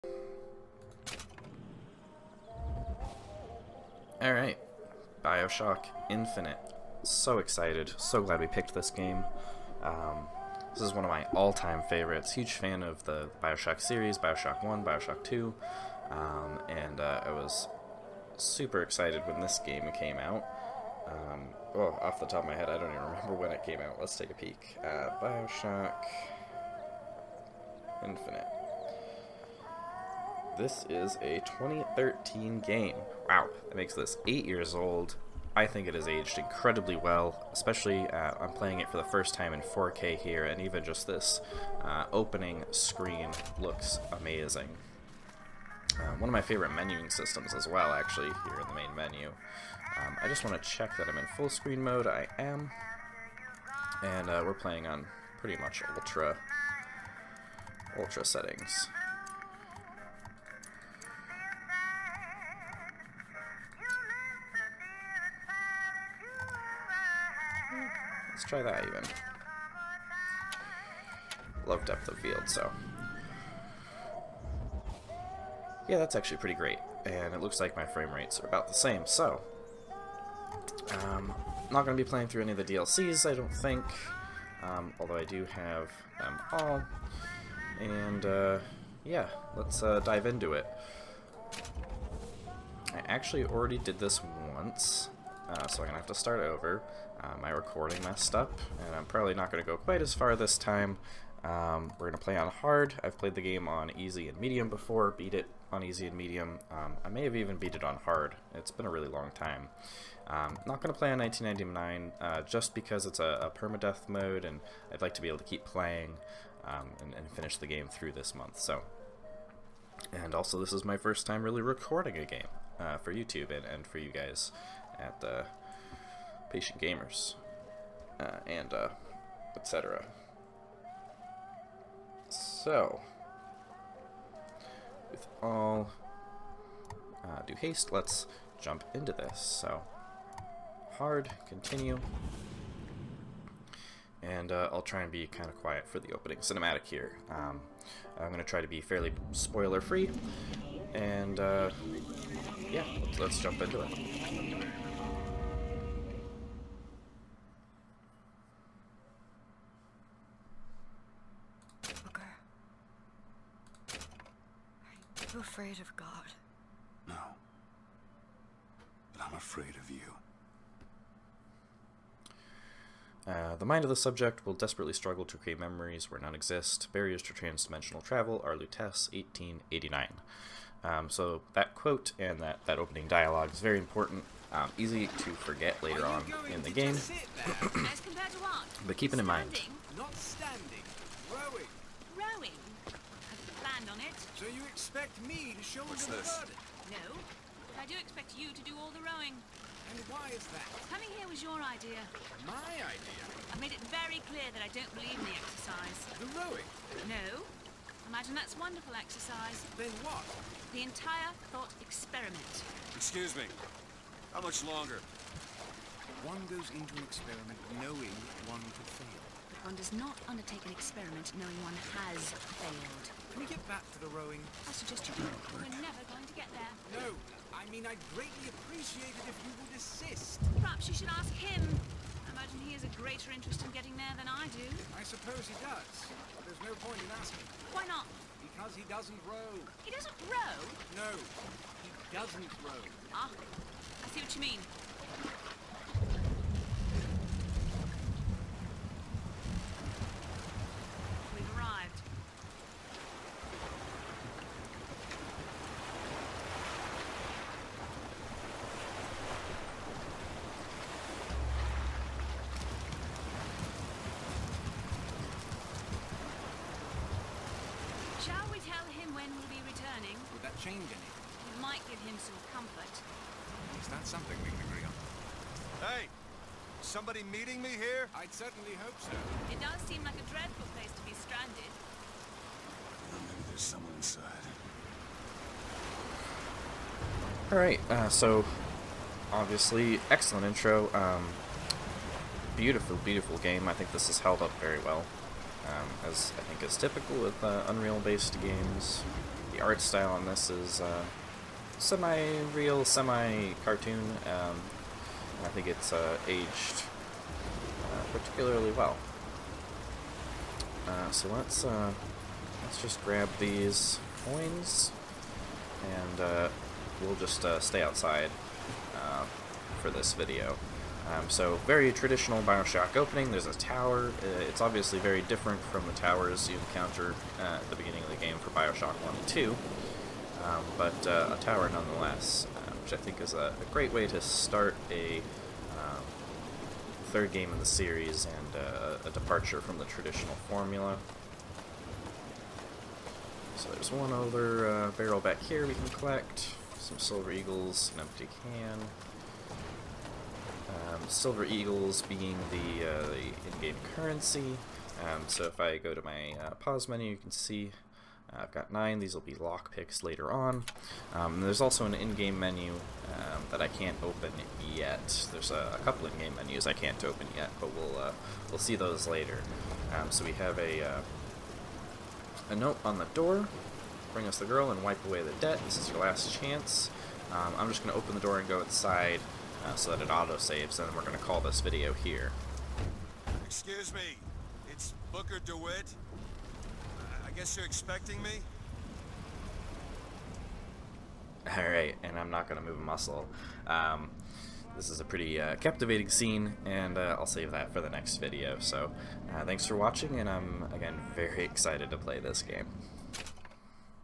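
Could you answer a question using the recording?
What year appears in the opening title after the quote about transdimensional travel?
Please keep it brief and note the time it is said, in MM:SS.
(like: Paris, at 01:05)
1889, at 02:59.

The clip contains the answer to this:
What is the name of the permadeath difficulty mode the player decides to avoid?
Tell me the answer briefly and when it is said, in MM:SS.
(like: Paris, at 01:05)
1999, at 01:51.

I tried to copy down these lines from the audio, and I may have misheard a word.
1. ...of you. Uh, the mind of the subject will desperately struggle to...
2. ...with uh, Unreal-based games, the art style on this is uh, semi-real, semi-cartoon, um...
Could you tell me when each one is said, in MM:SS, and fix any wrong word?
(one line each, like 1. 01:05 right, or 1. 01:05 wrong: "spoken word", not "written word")
1. 02:49 right
2. 04:57 right.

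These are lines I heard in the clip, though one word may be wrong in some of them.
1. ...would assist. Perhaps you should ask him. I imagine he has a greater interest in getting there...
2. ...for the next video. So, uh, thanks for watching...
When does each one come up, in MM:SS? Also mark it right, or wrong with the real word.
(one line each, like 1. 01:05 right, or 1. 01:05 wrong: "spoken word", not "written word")
1. 03:49 right
2. 06:37 right.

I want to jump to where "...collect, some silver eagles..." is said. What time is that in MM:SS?
05:45.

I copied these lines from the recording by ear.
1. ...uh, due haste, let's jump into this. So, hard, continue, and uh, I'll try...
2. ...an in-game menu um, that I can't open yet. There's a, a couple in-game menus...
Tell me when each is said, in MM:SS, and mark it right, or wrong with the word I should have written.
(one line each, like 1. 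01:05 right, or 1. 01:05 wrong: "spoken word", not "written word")
1. 02:17 right
2. 06:01 right.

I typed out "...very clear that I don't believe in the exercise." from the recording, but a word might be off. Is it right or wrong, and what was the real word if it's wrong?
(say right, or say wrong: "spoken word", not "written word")
right.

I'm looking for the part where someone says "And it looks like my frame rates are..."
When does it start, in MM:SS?
01:17.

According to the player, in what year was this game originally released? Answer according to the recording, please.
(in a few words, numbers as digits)
2013.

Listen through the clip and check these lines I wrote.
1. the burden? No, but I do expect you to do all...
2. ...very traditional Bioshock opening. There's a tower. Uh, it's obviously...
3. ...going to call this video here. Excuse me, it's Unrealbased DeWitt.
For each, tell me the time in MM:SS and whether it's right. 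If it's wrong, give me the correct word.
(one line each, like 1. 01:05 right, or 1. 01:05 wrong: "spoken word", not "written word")
1. 03:16 right
2. 05:21 right
3. 06:21 wrong: "Booker", not "Unrealbased".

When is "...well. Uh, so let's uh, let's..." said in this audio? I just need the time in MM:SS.
05:08.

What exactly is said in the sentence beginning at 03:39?
One does not undertake an experiment knowing one has failed.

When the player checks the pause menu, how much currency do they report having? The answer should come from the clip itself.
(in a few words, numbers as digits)
9.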